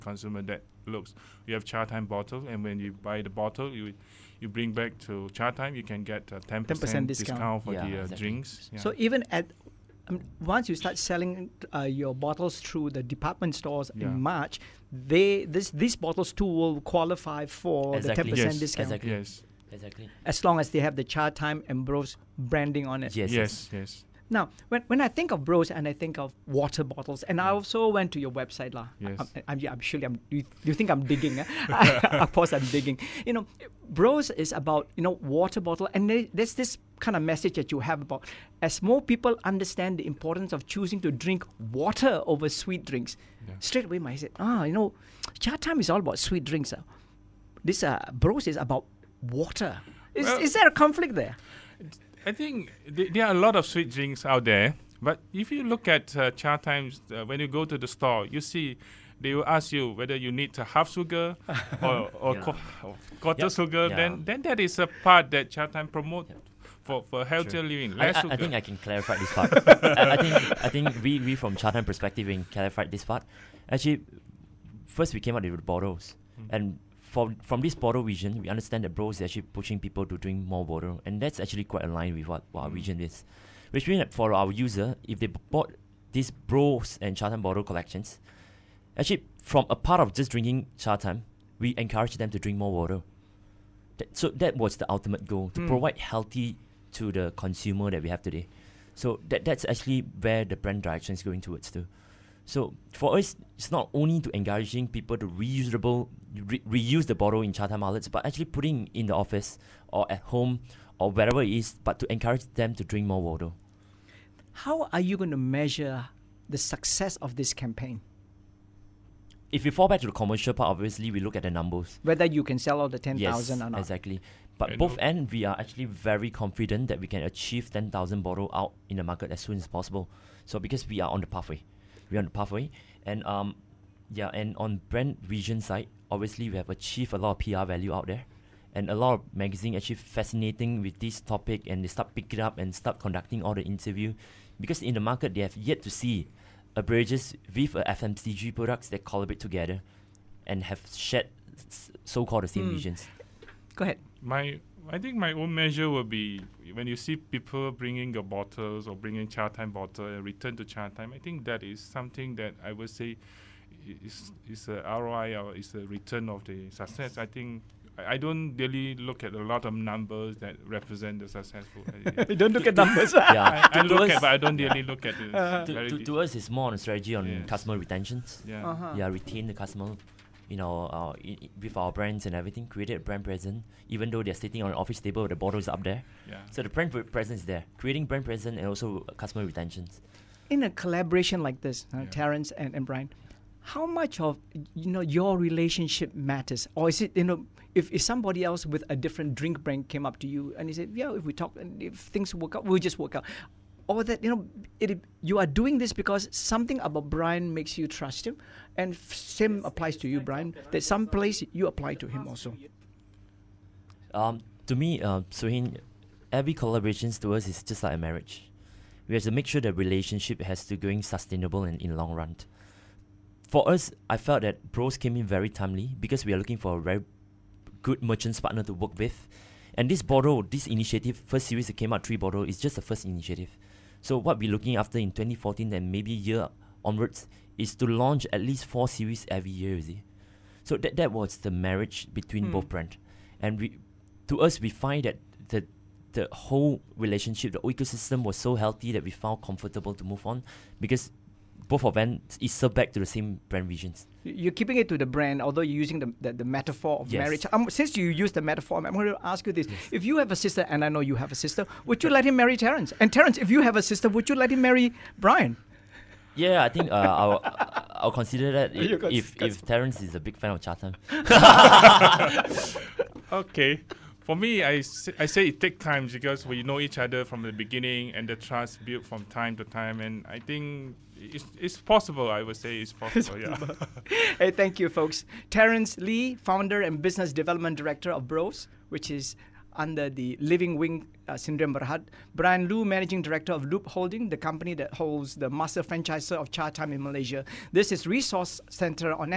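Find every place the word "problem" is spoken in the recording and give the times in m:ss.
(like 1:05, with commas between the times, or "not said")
not said.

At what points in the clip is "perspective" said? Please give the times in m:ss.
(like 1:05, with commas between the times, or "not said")
1:11.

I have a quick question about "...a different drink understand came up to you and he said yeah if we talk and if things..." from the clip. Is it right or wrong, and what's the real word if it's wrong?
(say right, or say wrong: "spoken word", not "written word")
wrong: "brand", not "understand".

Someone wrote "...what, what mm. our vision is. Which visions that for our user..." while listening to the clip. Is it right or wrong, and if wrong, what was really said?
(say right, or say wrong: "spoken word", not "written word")
wrong: "means", not "visions".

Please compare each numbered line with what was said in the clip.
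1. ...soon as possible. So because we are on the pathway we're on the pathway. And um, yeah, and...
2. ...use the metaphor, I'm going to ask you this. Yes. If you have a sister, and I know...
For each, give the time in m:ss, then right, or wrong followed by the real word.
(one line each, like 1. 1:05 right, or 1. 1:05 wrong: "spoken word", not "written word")
1. 2:09 right
2. 4:18 right.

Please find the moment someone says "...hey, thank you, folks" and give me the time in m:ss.
4:44.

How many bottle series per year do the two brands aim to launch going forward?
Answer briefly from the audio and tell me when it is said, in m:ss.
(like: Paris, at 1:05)
4, at 3:58.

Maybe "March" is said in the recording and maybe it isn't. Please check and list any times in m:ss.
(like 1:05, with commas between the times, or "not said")
0:14.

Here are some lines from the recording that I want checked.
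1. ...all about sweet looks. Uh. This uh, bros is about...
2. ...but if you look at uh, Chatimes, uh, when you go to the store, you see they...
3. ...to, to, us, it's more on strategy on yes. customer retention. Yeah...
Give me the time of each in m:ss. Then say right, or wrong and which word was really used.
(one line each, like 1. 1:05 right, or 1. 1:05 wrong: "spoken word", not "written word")
1. 0:45 wrong: "drinks", not "looks"
2. 0:55 right
3. 2:55 right.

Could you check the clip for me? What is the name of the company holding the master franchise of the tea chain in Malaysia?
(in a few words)
Loob Holding.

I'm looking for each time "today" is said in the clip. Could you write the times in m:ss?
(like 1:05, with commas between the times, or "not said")
1:38.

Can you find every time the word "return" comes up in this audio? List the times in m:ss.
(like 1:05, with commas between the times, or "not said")
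2:40, 2:45.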